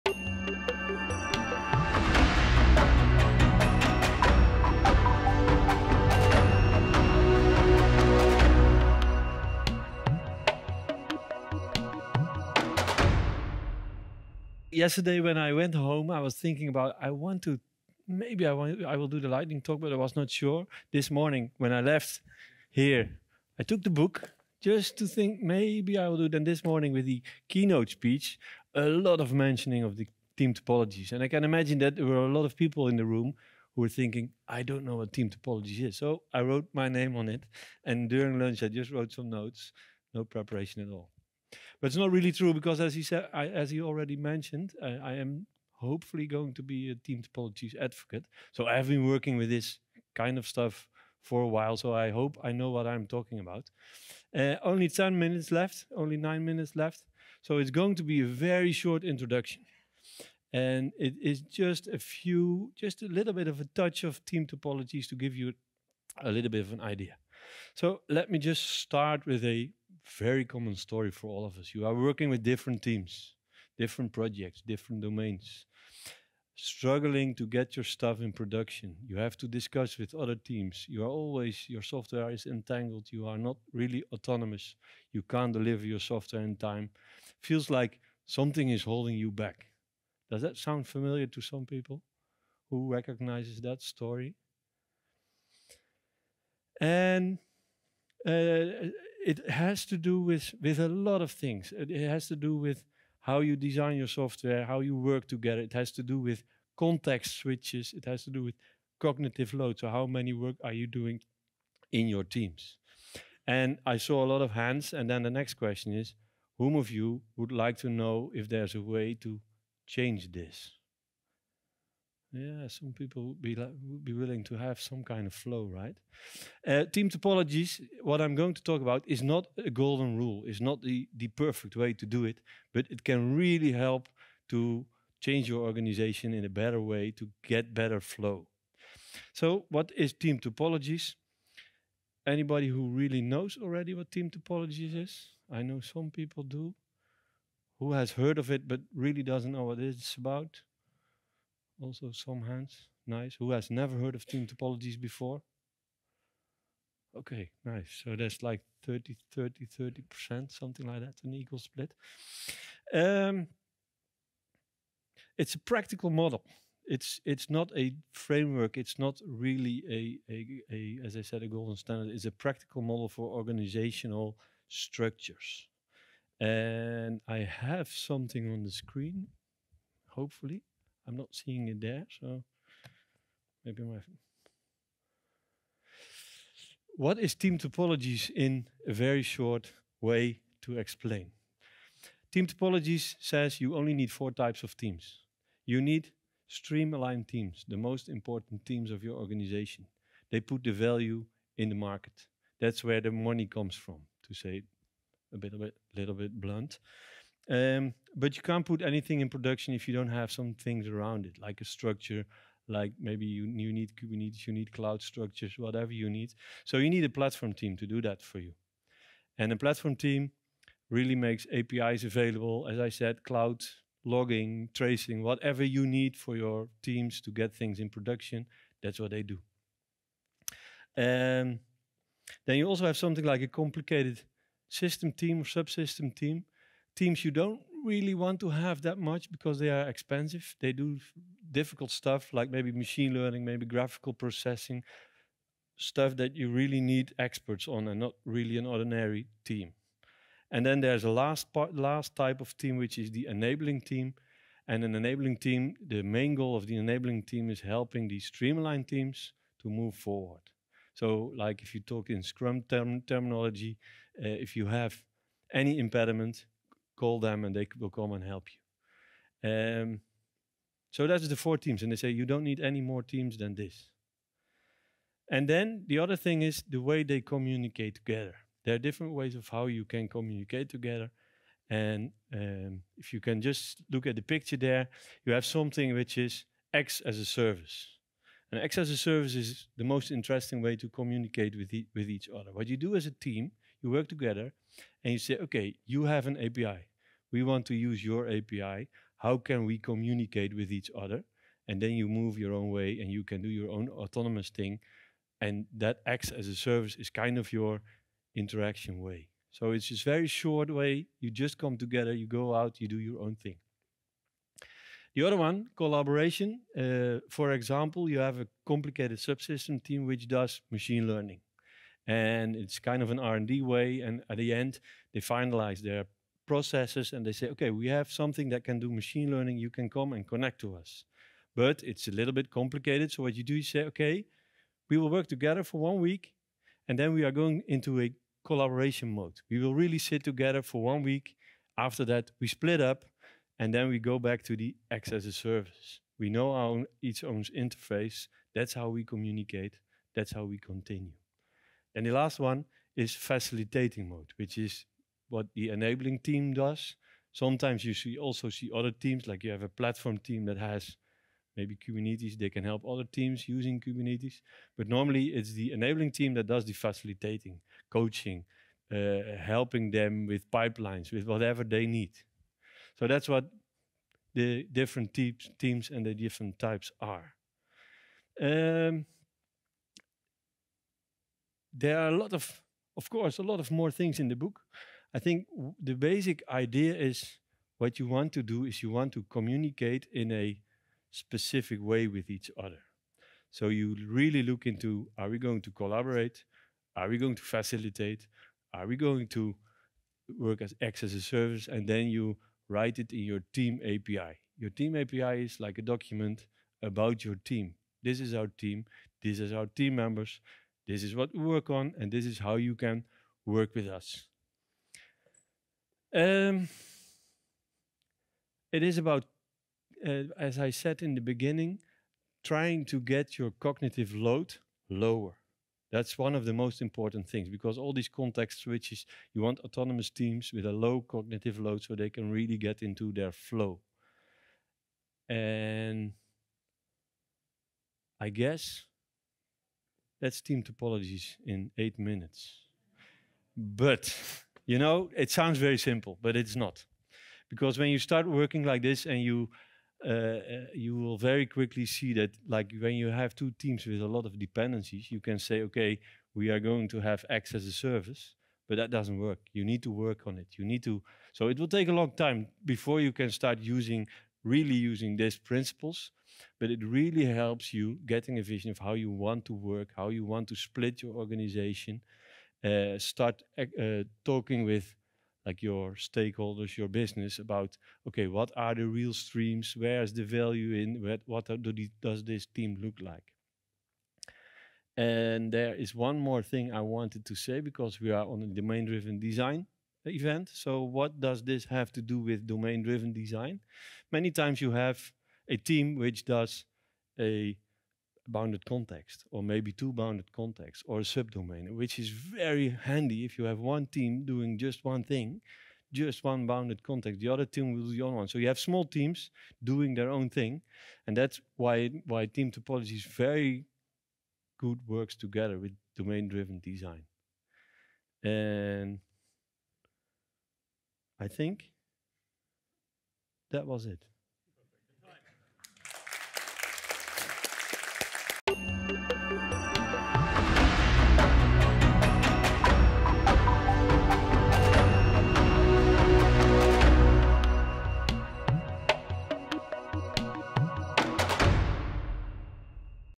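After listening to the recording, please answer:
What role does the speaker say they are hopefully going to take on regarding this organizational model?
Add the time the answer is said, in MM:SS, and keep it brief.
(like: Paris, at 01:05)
team topologies advocate, at 00:46.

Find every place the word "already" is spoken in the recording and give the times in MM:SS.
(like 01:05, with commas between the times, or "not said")
00:43, 02:23.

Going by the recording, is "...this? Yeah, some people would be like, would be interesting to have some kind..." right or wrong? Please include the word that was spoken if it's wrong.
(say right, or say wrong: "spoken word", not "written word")
wrong: "willing", not "interesting".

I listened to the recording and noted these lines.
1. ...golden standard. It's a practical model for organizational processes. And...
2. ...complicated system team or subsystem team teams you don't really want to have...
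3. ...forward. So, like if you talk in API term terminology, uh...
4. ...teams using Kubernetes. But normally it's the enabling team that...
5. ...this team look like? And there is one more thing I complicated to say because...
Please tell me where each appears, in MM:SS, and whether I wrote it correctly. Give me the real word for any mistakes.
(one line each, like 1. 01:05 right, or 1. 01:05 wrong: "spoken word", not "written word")
1. 02:51 wrong: "structures", not "processes"
2. 03:53 right
3. 04:19 wrong: "Scrum", not "API"
4. 06:03 right
5. 08:02 wrong: "wanted", not "complicated".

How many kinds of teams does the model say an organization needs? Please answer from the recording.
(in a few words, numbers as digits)
4.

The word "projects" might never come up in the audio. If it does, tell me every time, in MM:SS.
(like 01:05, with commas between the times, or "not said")
01:14.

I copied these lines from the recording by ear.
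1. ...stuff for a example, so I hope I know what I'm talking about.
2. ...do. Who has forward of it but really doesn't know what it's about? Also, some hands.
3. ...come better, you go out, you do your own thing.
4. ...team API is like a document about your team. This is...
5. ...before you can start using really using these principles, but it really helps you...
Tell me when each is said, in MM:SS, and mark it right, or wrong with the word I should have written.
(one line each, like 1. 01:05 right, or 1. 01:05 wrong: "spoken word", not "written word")
1. 00:50 wrong: "while", not "example"
2. 02:26 wrong: "heard", not "forward"
3. 05:11 wrong: "together", not "better"
4. 06:44 right
5. 07:42 right.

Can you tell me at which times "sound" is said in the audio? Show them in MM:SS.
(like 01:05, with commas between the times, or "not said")
01:30, 07:25.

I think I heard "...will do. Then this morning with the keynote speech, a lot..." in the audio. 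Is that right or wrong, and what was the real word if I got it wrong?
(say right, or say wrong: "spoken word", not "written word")
right.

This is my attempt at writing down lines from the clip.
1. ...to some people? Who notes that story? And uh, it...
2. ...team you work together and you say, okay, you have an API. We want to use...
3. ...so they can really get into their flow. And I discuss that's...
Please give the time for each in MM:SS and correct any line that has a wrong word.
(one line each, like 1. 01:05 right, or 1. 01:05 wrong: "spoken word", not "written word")
1. 01:31 wrong: "recognizes", not "notes"
2. 04:53 right
3. 07:11 wrong: "guess", not "discuss".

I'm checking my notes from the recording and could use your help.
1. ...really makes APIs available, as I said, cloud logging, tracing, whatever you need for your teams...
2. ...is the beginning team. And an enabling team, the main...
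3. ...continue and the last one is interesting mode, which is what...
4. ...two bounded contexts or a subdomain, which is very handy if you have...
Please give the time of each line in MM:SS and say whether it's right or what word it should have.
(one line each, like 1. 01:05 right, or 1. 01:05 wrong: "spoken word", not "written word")
1. 03:40 right
2. 04:12 wrong: "enabling", not "beginning"
3. 05:50 wrong: "facilitating", not "interesting"
4. 08:19 right.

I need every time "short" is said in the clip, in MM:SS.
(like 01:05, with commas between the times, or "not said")
00:58, 03:09, 05:10.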